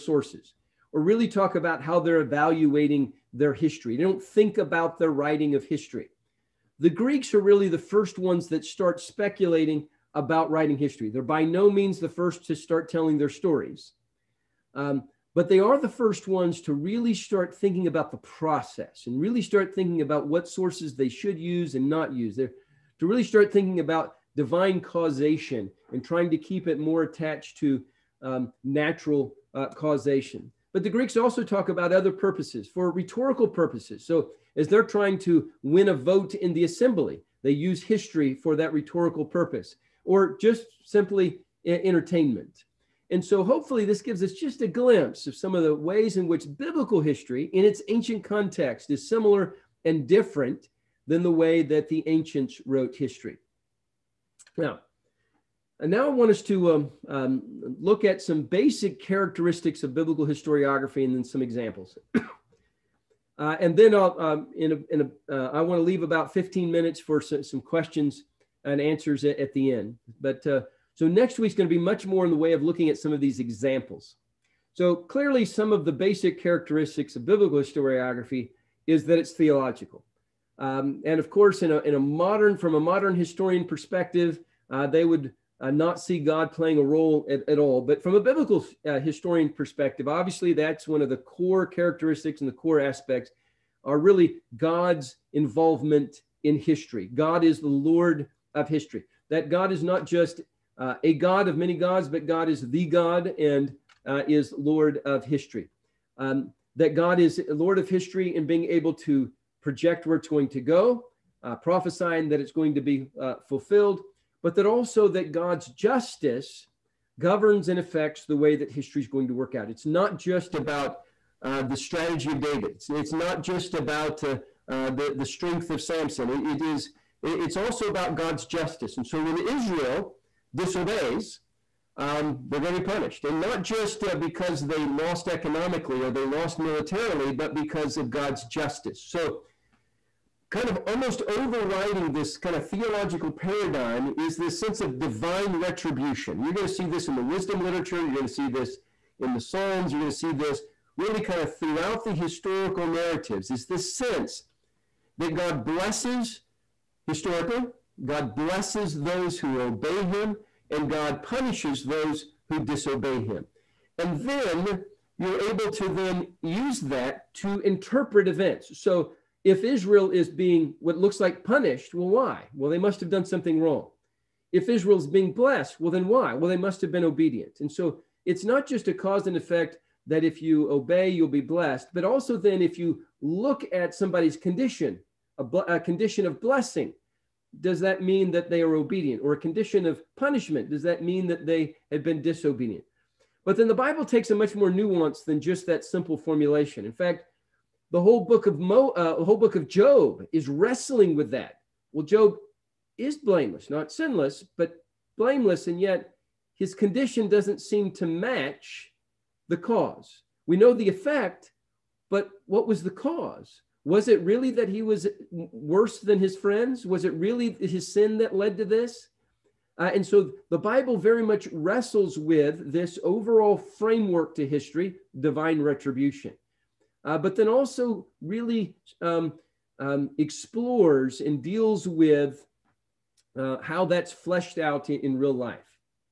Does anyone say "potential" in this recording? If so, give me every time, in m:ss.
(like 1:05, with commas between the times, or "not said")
not said.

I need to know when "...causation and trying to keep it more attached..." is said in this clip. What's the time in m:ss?
0:24.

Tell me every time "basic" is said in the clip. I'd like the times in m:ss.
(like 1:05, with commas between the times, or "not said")
0:58, 1:15.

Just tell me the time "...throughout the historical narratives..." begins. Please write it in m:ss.
2:31.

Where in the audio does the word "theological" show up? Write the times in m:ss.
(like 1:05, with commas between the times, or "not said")
1:19, 2:22.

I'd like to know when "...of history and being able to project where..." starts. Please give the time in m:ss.
1:47.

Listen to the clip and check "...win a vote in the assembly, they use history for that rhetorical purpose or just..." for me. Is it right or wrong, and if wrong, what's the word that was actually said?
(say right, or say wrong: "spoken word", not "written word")
right.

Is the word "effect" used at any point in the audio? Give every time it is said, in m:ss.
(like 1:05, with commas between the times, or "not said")
2:59, 3:30.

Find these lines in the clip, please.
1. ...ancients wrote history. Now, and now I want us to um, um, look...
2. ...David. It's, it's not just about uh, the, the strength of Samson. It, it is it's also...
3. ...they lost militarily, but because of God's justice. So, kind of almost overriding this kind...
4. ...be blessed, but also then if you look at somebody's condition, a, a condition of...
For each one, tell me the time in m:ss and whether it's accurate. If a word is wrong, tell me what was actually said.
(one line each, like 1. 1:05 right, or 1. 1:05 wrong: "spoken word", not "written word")
1. 0:52 right
2. 2:02 right
3. 2:16 right
4. 3:01 right.